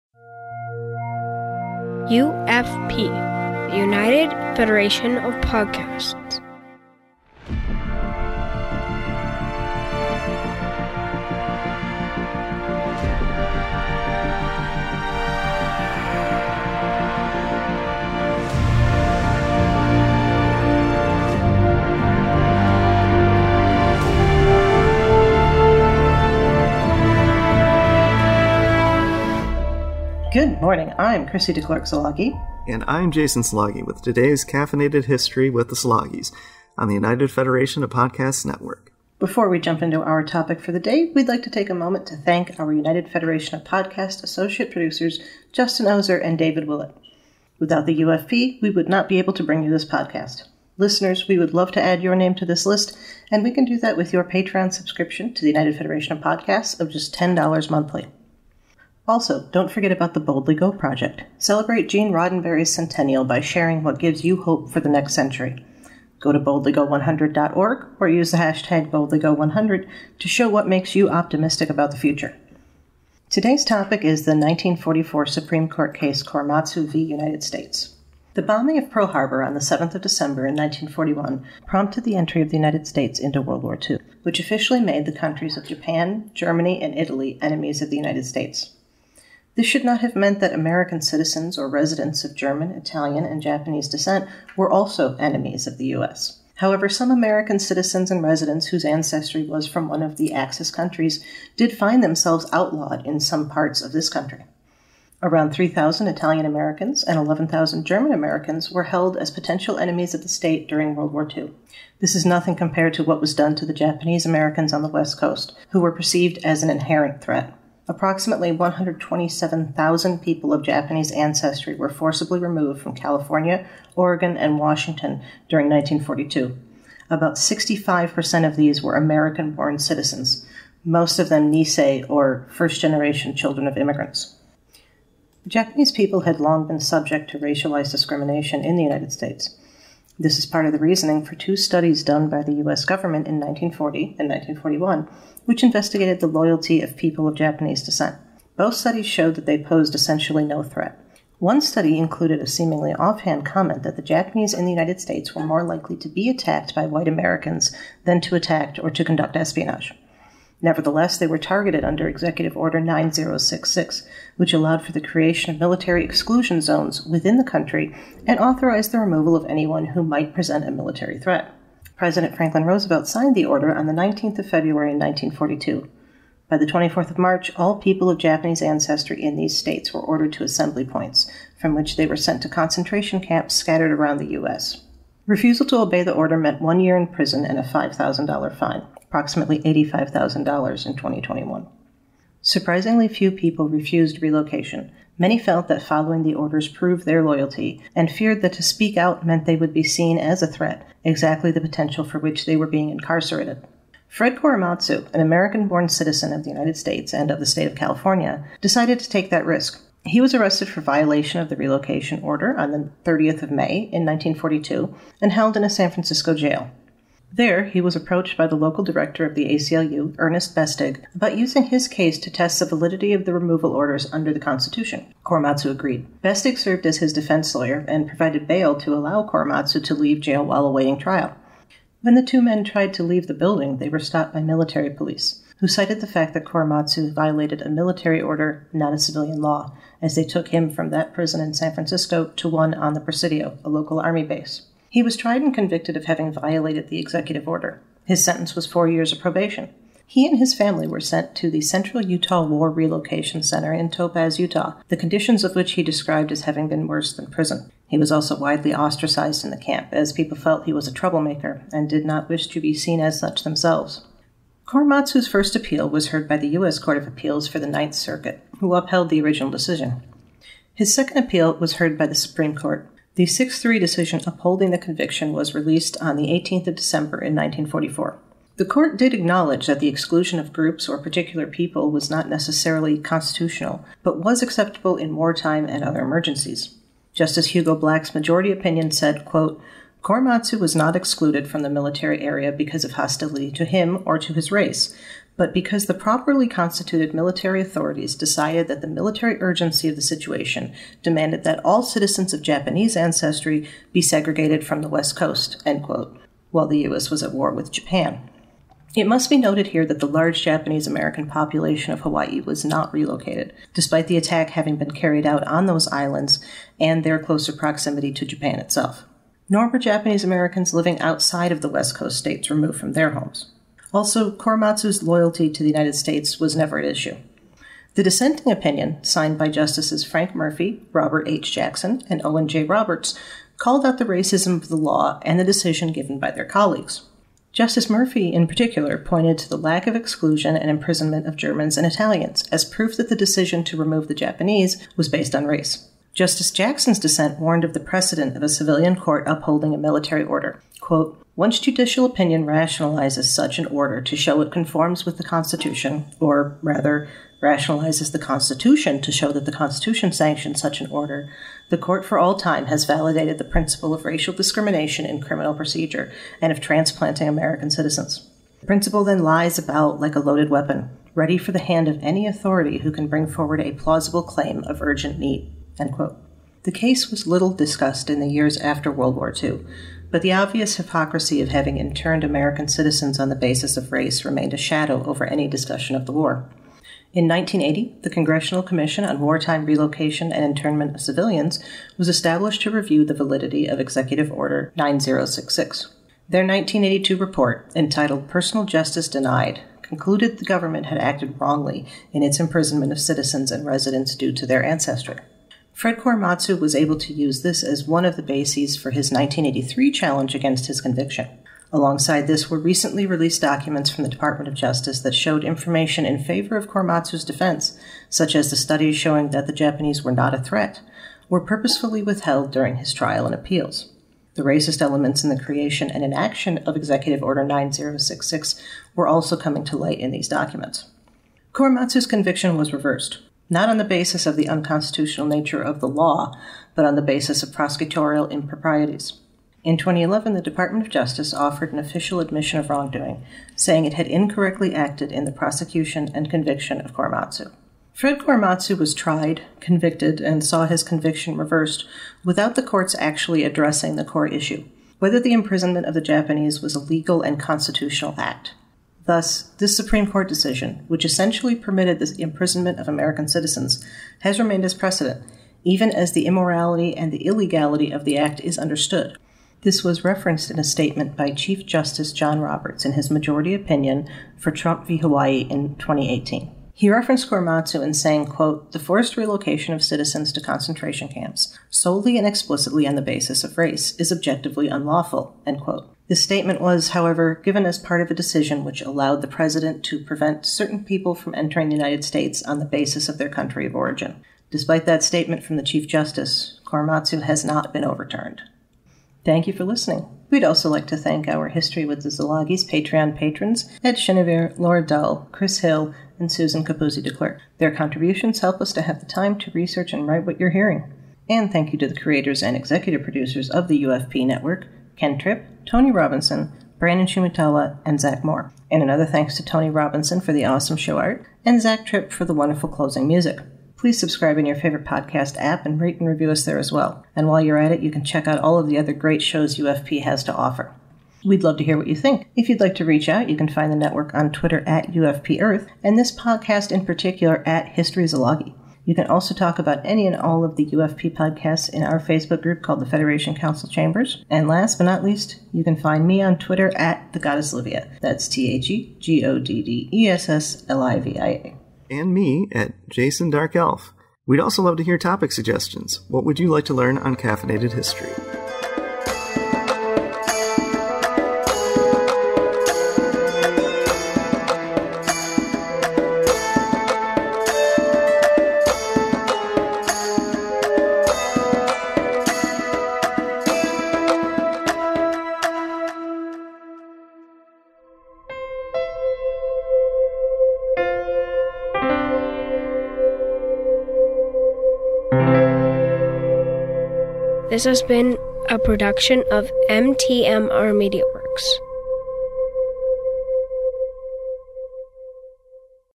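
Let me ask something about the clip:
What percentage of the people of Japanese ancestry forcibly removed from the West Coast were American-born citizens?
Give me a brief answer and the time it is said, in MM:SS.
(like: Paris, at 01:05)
65%, at 02:07.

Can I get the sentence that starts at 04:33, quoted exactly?
The 6 3 decision upholding the conviction was released on the 18th of December in 1944.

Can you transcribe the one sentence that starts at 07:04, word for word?
The racist elements in the creation and inaction of Executive Order 9066 were also coming to light in these documents.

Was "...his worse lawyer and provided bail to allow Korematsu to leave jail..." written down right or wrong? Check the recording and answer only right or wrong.
wrong.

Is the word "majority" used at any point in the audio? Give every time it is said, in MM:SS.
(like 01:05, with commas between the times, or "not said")
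04:48, 07:53.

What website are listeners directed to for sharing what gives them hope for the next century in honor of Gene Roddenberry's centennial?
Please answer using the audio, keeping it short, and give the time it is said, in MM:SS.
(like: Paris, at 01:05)
boldlygo100.org, at 01:06.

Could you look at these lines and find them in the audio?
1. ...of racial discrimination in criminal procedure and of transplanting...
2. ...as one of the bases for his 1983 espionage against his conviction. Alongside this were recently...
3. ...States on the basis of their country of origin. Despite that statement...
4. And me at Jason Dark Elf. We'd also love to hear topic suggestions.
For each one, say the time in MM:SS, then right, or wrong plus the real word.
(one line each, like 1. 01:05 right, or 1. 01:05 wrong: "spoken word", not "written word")
1. 06:03 right
2. 06:47 wrong: "challenge", not "espionage"
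3. 08:12 right
4. 09:11 right.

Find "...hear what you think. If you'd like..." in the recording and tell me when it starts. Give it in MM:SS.
08:51.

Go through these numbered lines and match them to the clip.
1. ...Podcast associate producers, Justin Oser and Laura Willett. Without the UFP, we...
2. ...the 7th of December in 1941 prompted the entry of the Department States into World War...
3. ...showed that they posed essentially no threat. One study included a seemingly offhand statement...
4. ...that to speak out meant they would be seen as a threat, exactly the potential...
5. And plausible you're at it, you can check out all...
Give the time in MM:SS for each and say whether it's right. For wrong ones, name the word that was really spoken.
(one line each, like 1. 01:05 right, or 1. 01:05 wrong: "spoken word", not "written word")
1. 00:43 wrong: "David", not "Laura"
2. 01:19 wrong: "United", not "Department"
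3. 02:29 wrong: "comment", not "statement"
4. 03:18 right
5. 08:47 wrong: "while", not "plausible".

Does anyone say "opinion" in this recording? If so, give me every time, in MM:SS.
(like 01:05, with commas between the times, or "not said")
04:48, 05:28, 05:52, 07:53.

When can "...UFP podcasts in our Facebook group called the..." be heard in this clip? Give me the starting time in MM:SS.
09:00.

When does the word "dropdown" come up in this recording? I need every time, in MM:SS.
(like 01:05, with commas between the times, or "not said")
not said.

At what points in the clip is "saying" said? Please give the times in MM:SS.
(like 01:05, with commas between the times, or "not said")
07:23, 07:57.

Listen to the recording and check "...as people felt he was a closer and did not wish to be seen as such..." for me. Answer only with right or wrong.
wrong.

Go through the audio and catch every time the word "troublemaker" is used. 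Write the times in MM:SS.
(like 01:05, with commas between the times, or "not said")
04:20.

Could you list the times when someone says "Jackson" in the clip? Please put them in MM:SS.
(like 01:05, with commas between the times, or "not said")
05:31, 05:46.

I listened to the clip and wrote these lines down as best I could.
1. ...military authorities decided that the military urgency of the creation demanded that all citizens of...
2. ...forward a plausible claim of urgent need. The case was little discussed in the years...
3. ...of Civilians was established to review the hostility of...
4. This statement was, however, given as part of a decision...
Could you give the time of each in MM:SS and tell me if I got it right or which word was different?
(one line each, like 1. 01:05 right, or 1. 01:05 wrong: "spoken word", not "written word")
1. 04:57 wrong: "situation", not "creation"
2. 06:13 right
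3. 06:30 wrong: "validity", not "hostility"
4. 08:06 right.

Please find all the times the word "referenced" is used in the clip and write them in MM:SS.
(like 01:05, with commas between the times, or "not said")
07:50, 07:56.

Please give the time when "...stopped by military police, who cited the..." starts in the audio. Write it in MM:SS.
03:53.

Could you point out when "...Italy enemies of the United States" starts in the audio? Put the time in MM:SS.
01:26.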